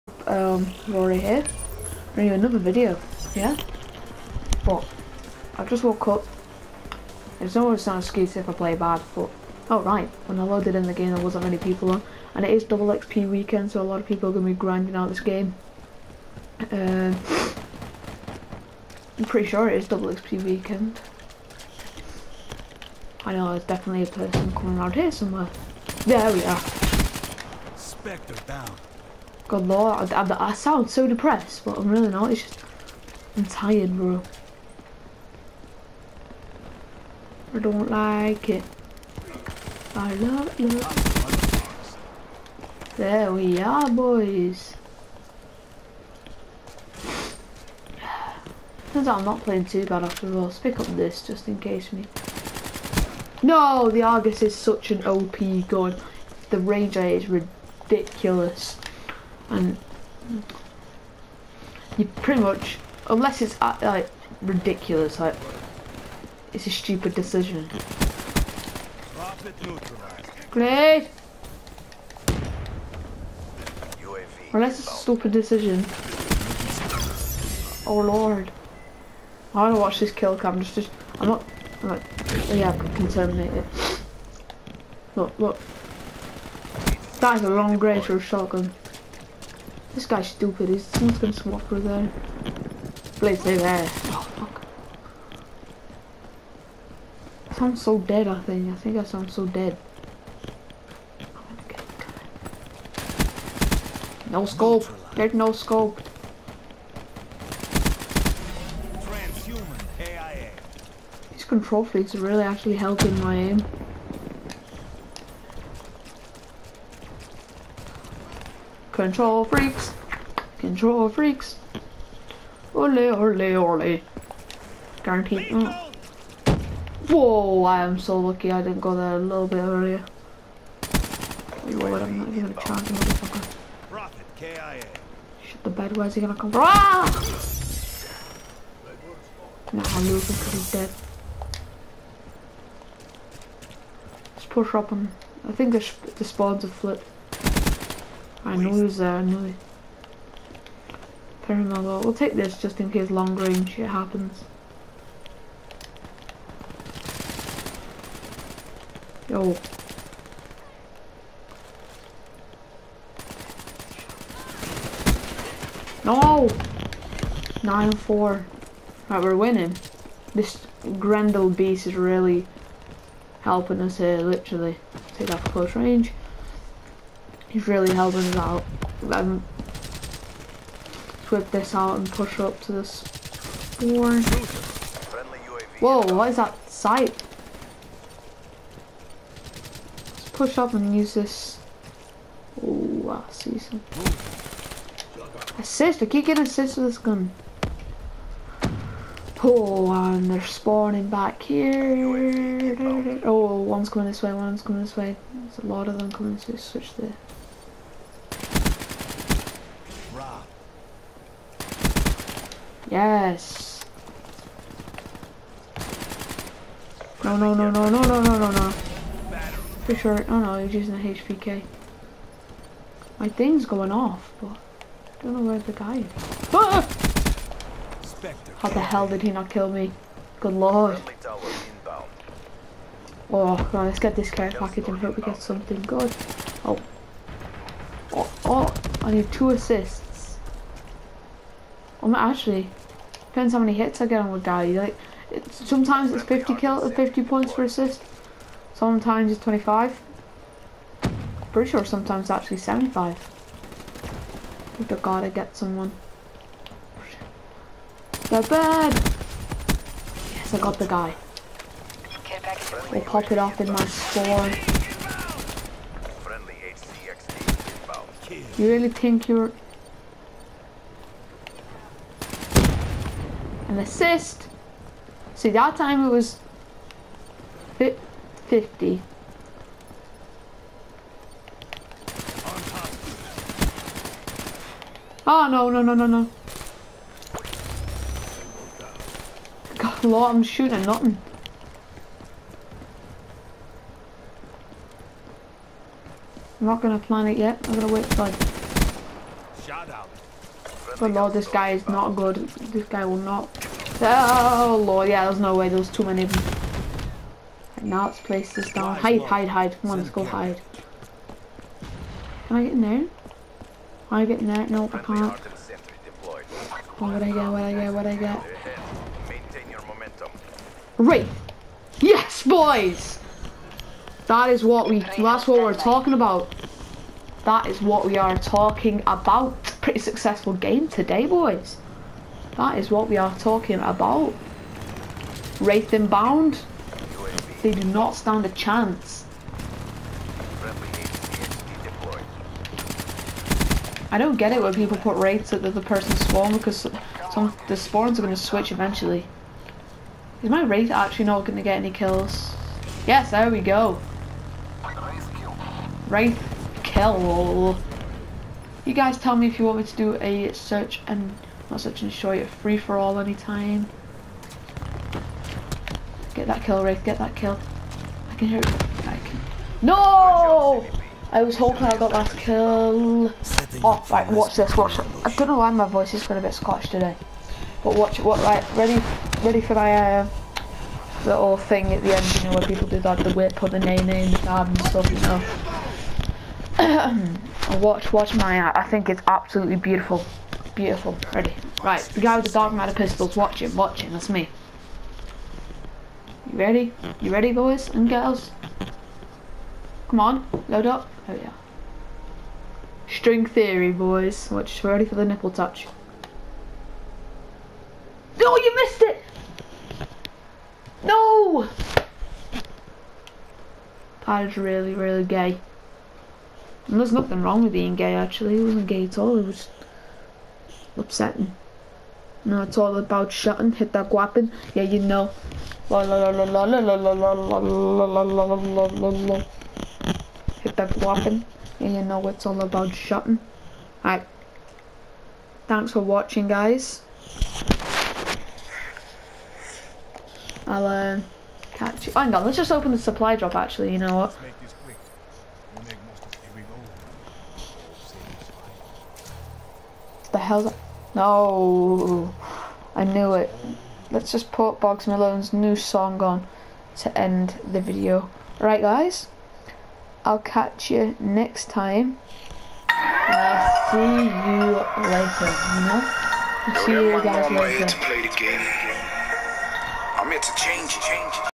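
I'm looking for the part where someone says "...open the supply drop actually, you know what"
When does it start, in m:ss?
7:22.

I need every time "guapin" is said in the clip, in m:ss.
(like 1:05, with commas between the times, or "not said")
7:04, 7:10.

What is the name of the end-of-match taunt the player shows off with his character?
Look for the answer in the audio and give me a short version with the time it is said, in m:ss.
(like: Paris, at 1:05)
String theory, at 6:43.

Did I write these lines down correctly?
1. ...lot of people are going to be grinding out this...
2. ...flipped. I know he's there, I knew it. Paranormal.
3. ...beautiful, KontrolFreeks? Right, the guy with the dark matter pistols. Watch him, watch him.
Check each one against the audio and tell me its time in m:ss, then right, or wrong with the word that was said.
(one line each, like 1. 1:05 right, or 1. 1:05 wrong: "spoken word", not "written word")
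1. 0:13 right
2. 2:26 right
3. 6:30 wrong: "Ready", not "KontrolFreeks".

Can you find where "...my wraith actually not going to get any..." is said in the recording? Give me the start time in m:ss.
5:50.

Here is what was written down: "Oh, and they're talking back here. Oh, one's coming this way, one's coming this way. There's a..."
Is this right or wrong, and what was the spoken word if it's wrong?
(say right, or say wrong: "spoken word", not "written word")
wrong: "spawning", not "talking".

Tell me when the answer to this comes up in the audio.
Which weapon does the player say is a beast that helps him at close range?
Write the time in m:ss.
2:50.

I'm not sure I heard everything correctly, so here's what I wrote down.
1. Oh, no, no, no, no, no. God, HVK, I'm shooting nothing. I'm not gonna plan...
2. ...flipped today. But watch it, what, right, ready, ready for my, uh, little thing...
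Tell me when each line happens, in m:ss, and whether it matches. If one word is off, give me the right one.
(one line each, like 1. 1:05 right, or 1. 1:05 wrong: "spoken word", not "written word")
1. 4:45 wrong: "Lord", not "HVK"
2. 6:16 wrong: "squashed", not "flipped".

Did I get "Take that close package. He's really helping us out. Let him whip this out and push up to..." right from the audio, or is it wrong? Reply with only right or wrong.
wrong.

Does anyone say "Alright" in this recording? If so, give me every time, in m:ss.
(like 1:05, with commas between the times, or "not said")
7:14.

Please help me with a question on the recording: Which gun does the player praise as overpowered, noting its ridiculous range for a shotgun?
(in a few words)
Argus.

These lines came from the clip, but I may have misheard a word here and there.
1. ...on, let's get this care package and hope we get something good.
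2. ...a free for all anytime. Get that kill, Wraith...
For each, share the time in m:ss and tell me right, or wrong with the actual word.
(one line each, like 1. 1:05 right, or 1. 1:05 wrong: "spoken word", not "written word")
1. 3:53 right
2. 6:02 right.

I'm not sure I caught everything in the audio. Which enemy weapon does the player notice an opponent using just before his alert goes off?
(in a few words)
HVK.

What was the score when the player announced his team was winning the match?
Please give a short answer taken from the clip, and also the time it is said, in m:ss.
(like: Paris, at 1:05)
9-4, at 2:47.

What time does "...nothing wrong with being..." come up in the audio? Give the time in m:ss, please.
6:57.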